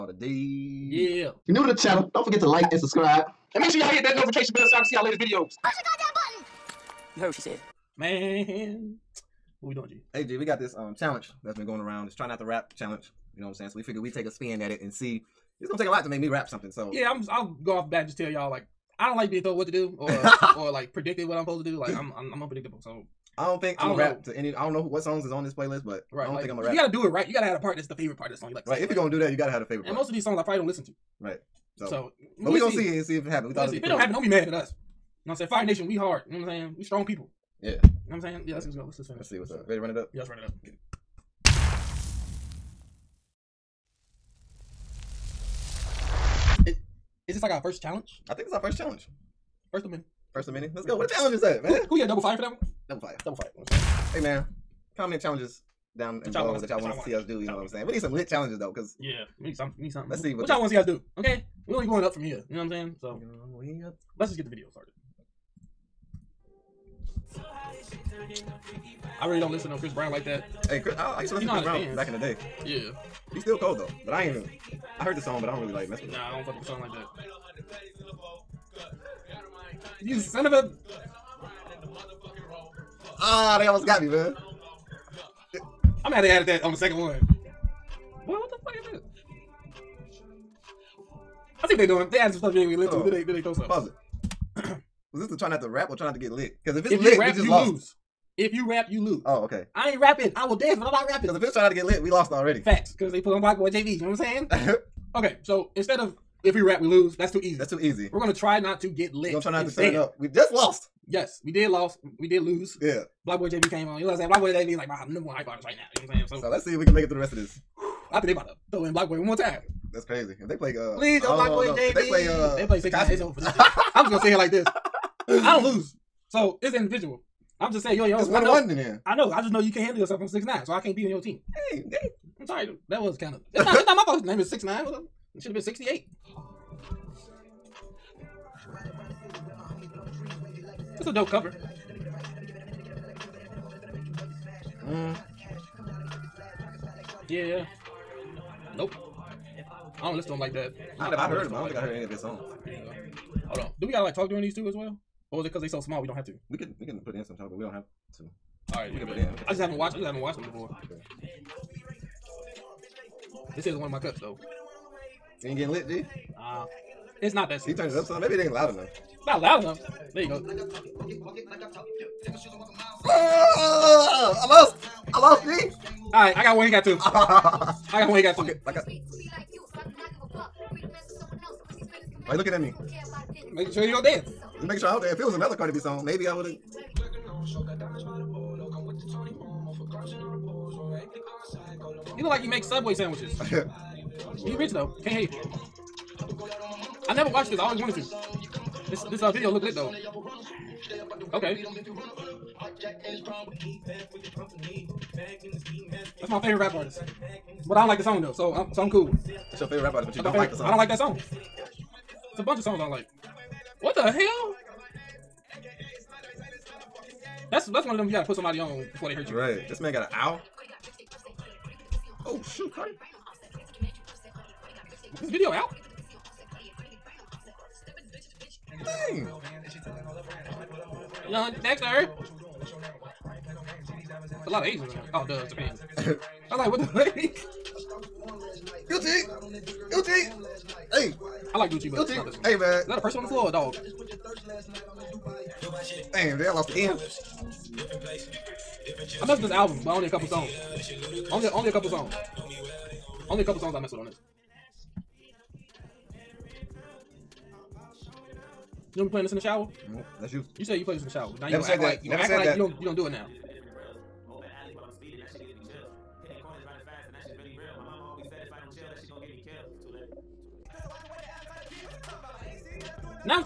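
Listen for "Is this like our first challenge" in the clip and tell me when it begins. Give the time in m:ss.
0:47.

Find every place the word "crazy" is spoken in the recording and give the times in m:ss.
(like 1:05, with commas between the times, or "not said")
2:00.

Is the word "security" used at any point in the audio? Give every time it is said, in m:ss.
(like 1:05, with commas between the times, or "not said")
not said.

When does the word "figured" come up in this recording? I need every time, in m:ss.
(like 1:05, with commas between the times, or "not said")
0:13.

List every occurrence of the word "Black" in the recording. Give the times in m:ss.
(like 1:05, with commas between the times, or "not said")
1:43, 2:01.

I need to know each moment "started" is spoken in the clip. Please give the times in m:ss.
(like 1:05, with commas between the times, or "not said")
1:04.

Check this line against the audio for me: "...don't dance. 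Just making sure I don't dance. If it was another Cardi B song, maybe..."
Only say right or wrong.
right.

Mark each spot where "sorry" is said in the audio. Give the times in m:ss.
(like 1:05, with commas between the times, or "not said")
2:12.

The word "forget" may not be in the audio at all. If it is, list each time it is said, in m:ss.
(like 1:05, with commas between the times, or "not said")
0:02.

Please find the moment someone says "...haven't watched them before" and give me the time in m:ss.
2:40.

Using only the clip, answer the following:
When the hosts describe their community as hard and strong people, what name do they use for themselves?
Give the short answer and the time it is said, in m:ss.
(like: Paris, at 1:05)
Fire Nation, at 0:35.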